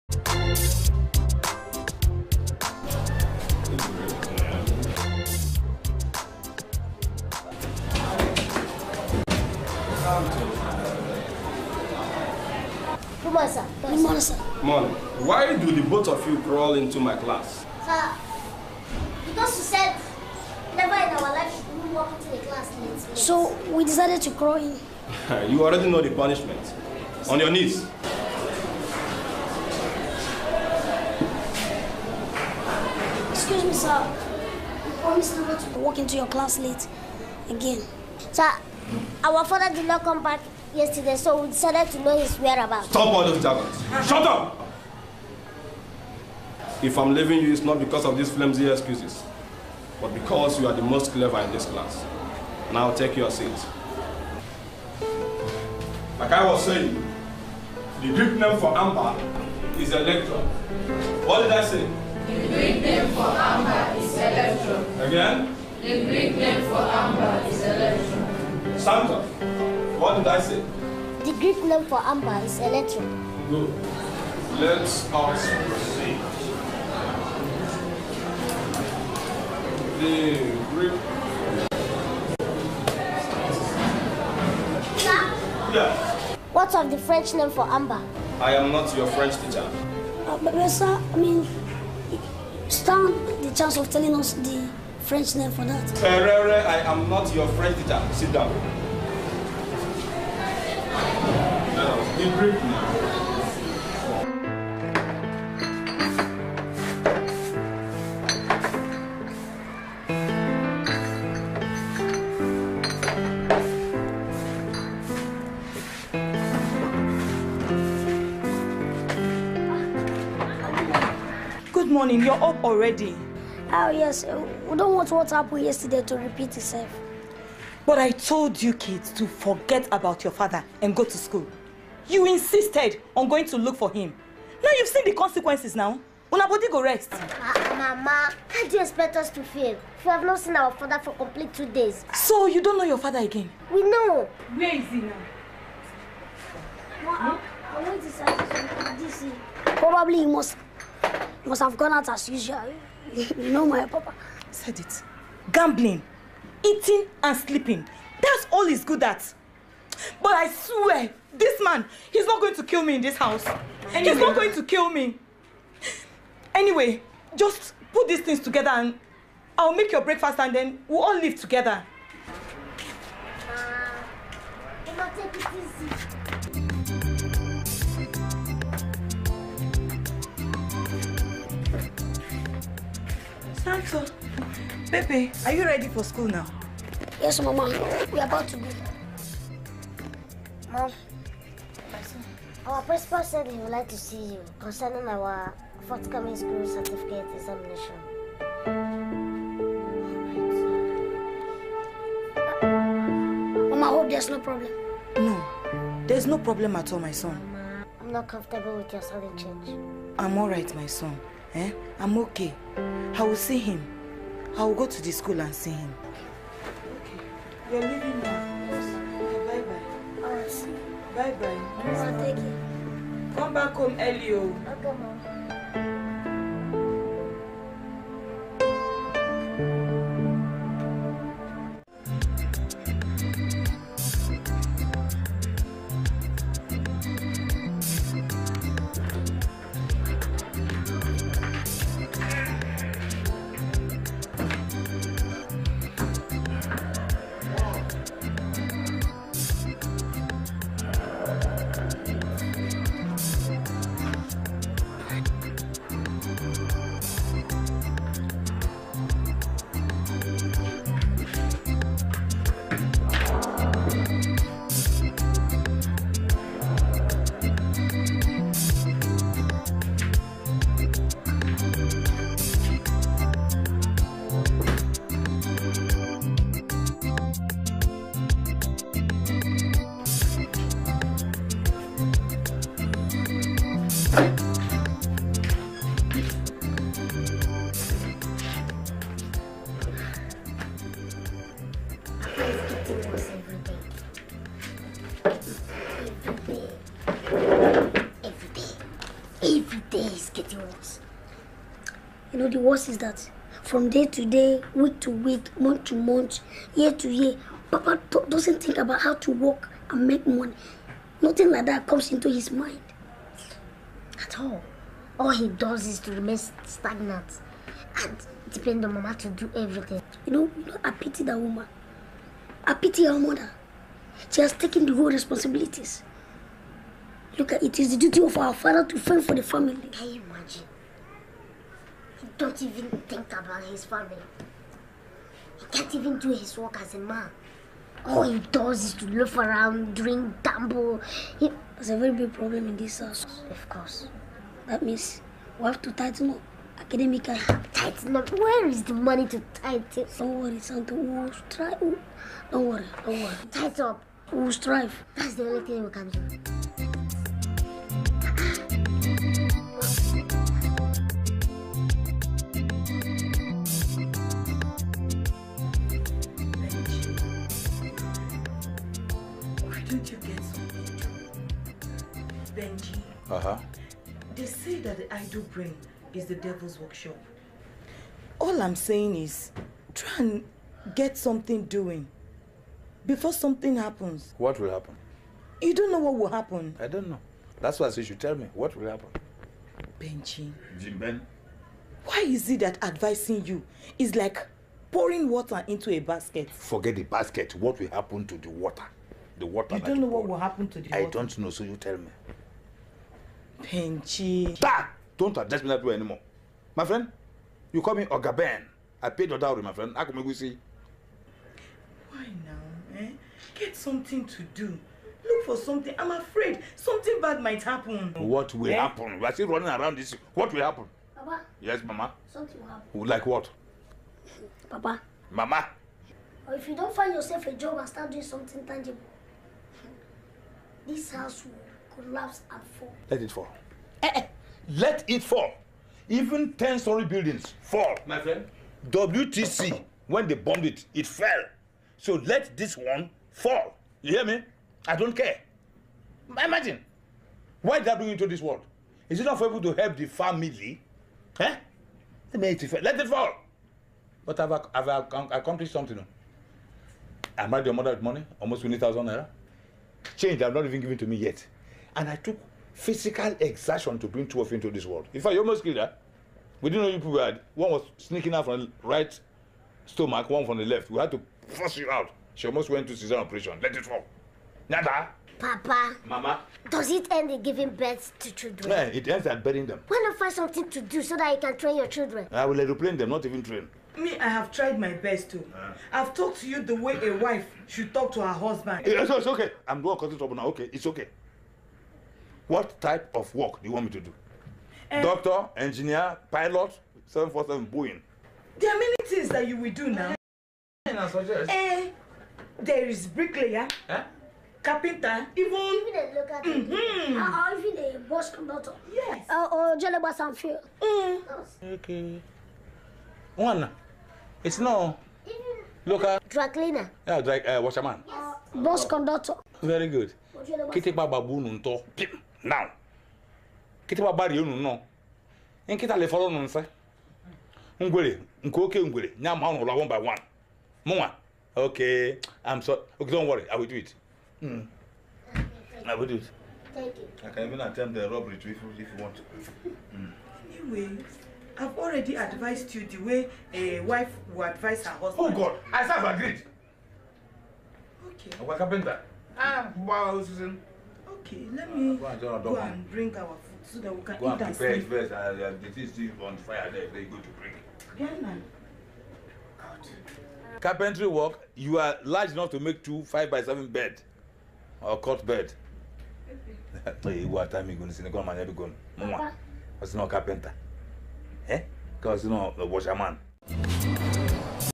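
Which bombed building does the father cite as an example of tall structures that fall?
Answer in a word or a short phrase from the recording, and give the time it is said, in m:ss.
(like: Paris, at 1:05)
WTC, at 7:18.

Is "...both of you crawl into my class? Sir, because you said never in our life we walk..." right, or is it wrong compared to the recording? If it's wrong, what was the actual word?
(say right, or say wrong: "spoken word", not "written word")
right.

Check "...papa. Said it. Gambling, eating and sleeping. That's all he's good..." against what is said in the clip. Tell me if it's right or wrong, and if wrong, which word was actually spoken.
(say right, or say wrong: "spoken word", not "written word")
right.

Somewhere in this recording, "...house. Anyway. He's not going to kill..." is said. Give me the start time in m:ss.
2:43.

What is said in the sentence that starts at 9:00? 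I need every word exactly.
Anyway, I've already advised you the way a wife will advise her husband.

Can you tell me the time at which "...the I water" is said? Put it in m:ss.
6:40.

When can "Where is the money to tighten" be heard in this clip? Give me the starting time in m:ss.
5:48.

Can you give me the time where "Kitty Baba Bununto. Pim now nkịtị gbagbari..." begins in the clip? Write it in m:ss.
8:40.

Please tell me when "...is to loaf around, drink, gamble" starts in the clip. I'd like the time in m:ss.
5:38.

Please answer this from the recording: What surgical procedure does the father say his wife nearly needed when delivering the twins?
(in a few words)
cesarean operation.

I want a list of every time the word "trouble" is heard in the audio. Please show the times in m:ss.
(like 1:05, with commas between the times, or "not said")
8:10.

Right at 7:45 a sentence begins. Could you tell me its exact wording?
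In fact, you almost killed her.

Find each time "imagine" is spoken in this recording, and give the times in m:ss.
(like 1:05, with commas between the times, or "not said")
5:30, 7:26.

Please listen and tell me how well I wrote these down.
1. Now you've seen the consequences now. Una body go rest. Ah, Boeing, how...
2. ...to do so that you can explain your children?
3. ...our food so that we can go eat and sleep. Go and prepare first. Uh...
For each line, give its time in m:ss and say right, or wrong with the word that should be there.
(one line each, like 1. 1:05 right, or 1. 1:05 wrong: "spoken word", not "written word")
1. 2:14 wrong: "Mama", not "Boeing"
2. 8:00 wrong: "train", not "explain"
3. 9:13 right.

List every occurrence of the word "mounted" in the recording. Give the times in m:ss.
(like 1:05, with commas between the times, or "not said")
not said.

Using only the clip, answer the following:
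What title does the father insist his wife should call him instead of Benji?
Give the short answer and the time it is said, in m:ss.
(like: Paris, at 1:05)
Ogaben, at 6:48.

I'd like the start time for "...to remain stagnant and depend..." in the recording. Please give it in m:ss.
5:16.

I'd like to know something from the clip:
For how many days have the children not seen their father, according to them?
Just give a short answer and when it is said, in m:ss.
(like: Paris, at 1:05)
2, at 2:21.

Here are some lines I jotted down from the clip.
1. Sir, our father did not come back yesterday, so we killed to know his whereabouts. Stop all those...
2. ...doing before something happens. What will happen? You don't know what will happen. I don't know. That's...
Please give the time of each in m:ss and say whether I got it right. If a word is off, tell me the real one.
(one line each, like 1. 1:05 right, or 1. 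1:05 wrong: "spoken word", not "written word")
1. 0:38 wrong: "decided", not "killed"
2. 6:21 right.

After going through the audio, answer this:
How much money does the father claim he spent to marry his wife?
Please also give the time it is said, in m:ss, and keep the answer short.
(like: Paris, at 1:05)
20,000 naira, at 7:38.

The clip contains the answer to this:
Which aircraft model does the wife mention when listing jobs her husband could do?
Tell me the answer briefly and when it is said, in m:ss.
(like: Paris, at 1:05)
747 Boeing, at 8:17.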